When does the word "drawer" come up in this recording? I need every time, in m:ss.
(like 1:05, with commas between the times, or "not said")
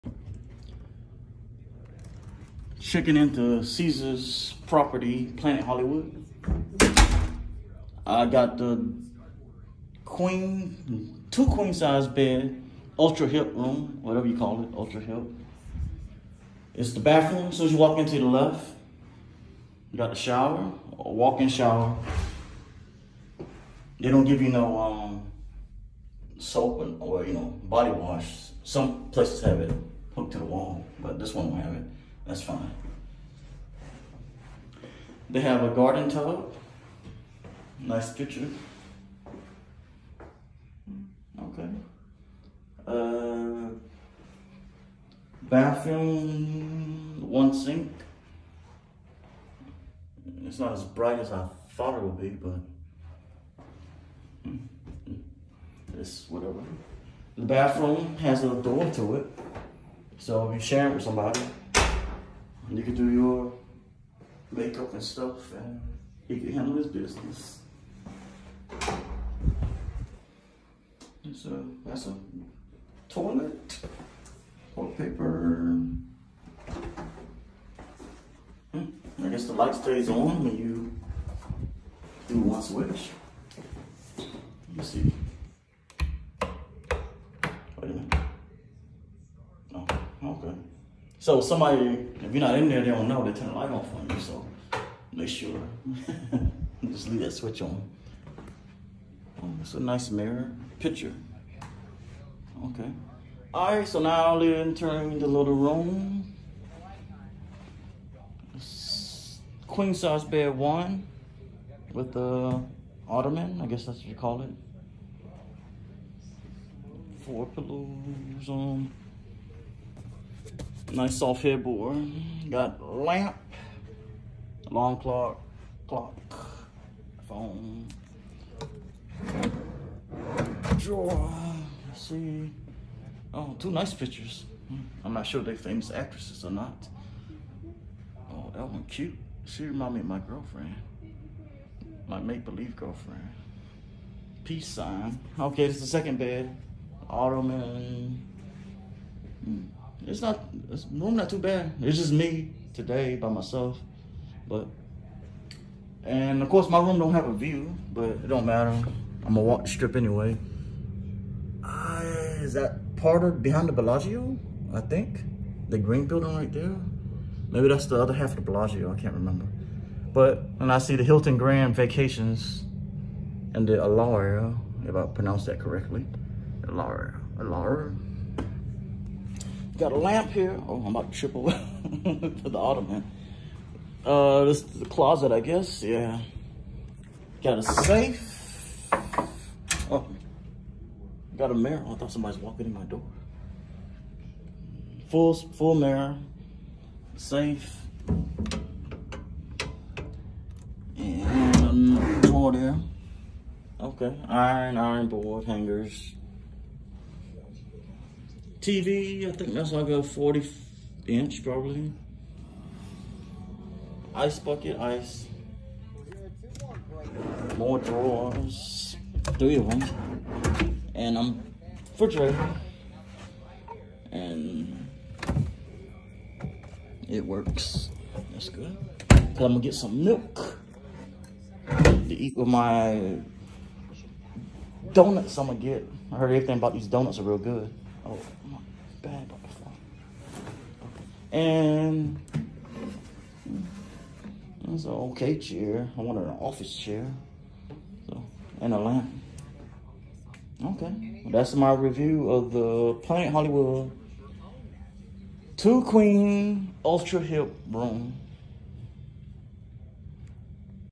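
2:10, 3:22, 3:37.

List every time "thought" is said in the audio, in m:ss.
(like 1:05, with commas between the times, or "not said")
0:51, 3:11.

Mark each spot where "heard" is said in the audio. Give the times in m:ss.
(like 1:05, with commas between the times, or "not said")
3:56.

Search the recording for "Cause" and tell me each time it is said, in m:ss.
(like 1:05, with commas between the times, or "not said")
3:49.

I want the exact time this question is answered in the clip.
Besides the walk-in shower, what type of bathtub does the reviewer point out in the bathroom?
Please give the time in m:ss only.
0:35.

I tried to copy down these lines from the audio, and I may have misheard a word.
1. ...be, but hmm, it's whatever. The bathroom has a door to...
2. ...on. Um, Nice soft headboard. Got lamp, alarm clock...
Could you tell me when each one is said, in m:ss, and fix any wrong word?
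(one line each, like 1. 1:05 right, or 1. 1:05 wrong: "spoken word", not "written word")
1. 0:52 right
2. 1:58 right.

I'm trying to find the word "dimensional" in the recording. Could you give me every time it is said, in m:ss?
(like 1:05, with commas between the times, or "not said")
not said.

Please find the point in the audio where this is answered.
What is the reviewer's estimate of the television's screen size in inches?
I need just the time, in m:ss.
3:30.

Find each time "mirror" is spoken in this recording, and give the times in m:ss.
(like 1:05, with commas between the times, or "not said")
1:40, 3:11, 3:15.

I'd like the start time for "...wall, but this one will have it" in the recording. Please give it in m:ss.
0:30.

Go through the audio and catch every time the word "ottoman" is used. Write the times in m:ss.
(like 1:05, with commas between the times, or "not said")
1:53, 2:27, 3:02.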